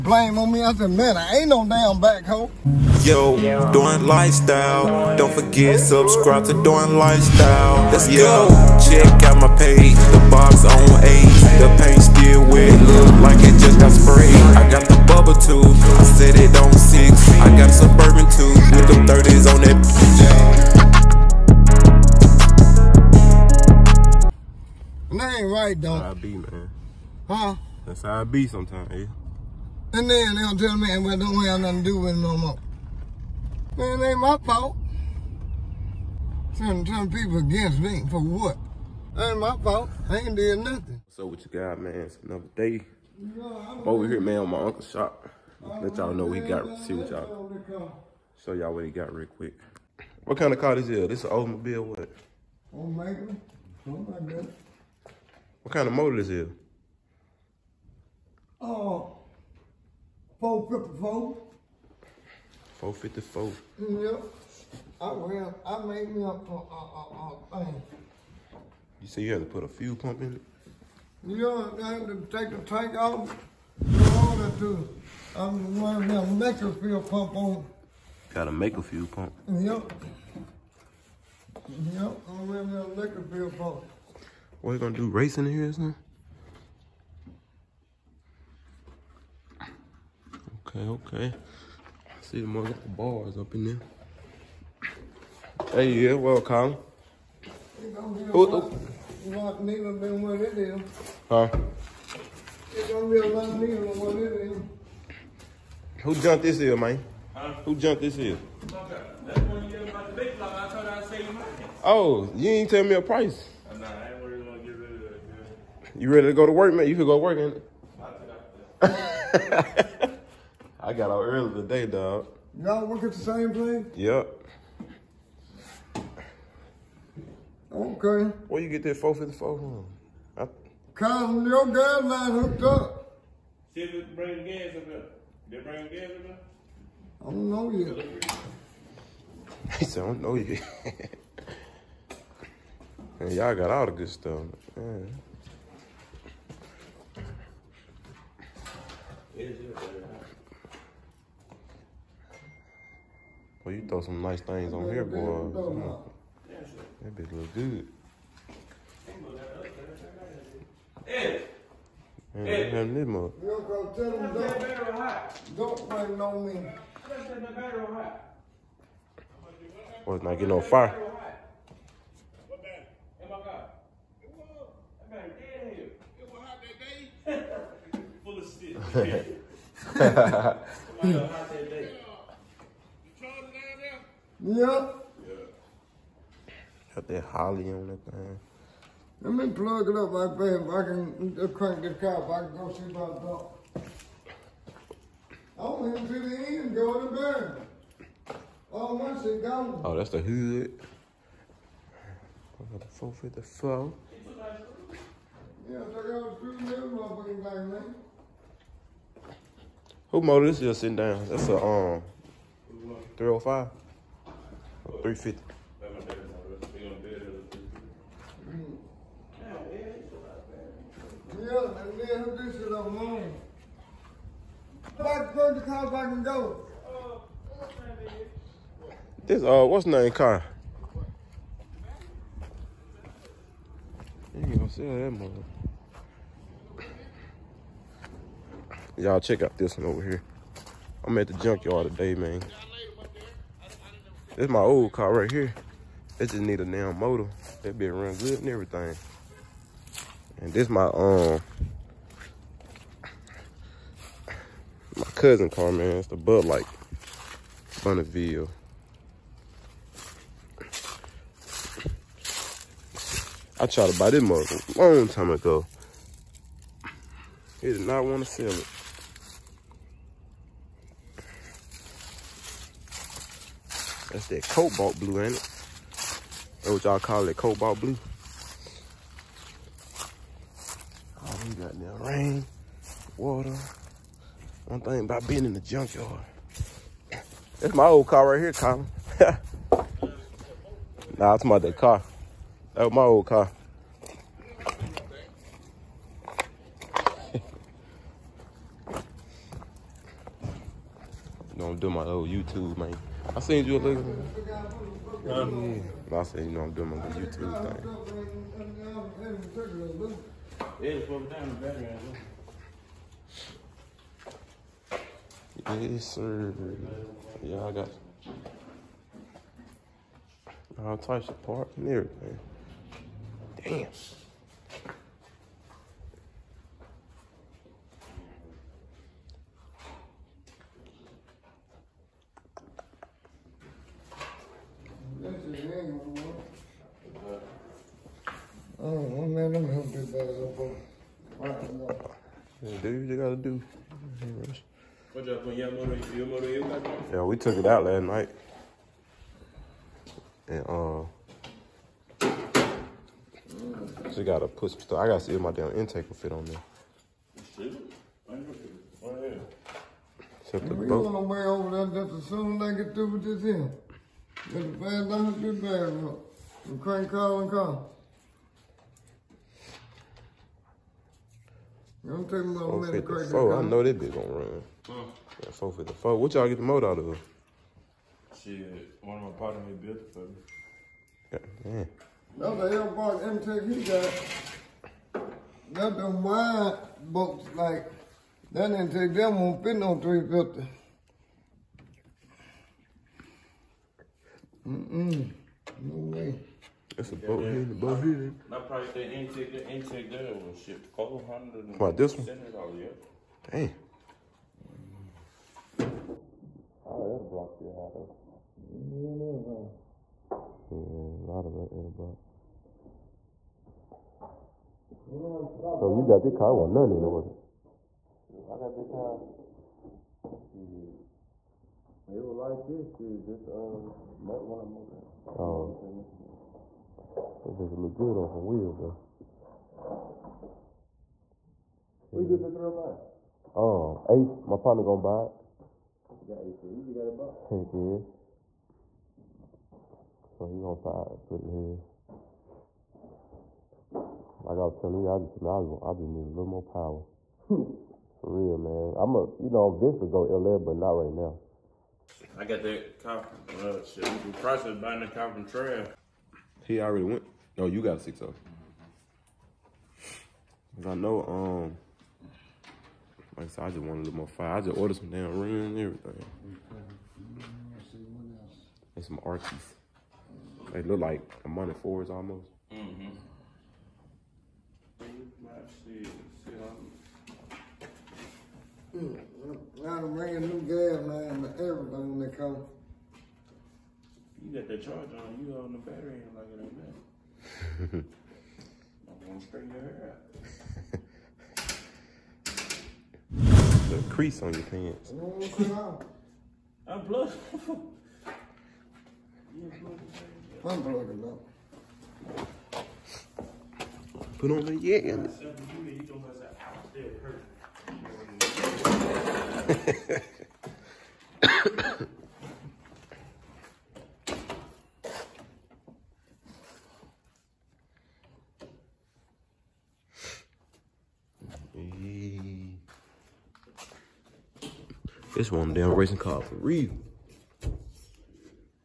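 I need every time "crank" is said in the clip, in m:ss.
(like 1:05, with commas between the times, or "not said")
3:11, 6:06.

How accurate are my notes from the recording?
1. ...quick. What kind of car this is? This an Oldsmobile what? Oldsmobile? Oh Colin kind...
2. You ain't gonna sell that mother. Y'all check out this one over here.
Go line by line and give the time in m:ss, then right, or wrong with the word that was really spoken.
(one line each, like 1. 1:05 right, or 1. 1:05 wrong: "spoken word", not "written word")
1. 0:49 wrong: "What", not "Colin"
2. 3:54 right.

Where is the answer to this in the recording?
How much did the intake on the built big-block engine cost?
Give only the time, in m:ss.
6:40.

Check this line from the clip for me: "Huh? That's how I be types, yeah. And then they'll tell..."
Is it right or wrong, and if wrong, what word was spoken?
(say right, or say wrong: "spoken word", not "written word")
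wrong: "sometimes", not "types".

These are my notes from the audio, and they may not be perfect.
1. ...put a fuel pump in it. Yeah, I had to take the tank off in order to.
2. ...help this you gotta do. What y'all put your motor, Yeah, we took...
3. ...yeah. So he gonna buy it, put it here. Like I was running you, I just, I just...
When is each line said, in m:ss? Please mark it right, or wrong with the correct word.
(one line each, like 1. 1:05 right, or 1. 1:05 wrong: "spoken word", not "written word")
1. 1:09 right
2. 5:39 right
3. 7:17 wrong: "telling", not "running".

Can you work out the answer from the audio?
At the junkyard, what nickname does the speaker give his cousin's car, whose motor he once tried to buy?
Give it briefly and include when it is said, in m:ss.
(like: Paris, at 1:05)
Bud Light Bonneville, at 4:16.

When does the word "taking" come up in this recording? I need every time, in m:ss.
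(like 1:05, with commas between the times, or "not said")
6:12.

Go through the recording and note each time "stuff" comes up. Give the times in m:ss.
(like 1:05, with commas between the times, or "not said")
2:24, 5:54.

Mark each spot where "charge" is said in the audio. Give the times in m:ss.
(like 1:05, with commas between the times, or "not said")
8:04.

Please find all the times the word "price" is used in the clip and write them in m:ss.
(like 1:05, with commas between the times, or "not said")
1:53, 6:38.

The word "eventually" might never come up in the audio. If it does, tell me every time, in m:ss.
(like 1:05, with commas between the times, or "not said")
7:29.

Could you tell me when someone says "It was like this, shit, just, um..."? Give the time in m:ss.
7:02.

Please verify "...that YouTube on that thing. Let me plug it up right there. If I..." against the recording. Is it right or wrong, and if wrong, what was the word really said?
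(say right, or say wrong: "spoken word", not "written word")
wrong: "Holley", not "YouTube".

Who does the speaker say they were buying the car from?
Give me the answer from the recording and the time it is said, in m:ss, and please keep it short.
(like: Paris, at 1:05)
Trail, at 7:35.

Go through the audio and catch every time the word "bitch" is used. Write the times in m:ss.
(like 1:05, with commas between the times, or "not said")
2:37, 6:13, 7:07.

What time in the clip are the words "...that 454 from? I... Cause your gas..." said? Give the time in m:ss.
2:08.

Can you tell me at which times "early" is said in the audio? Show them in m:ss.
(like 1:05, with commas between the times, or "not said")
2:01.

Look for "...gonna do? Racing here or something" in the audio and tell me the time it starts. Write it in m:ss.
1:24.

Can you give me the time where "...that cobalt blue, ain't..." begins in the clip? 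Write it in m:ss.
4:34.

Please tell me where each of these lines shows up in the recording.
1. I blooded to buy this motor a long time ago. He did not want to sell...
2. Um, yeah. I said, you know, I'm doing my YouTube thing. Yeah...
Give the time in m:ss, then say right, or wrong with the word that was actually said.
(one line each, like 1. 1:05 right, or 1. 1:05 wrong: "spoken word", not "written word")
1. 4:23 wrong: "tried", not "blooded"
2. 5:05 right.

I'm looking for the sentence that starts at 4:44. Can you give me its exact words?
One thing about being in the junkyard.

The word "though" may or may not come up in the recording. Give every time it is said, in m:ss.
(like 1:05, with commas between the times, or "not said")
0:25, 6:47.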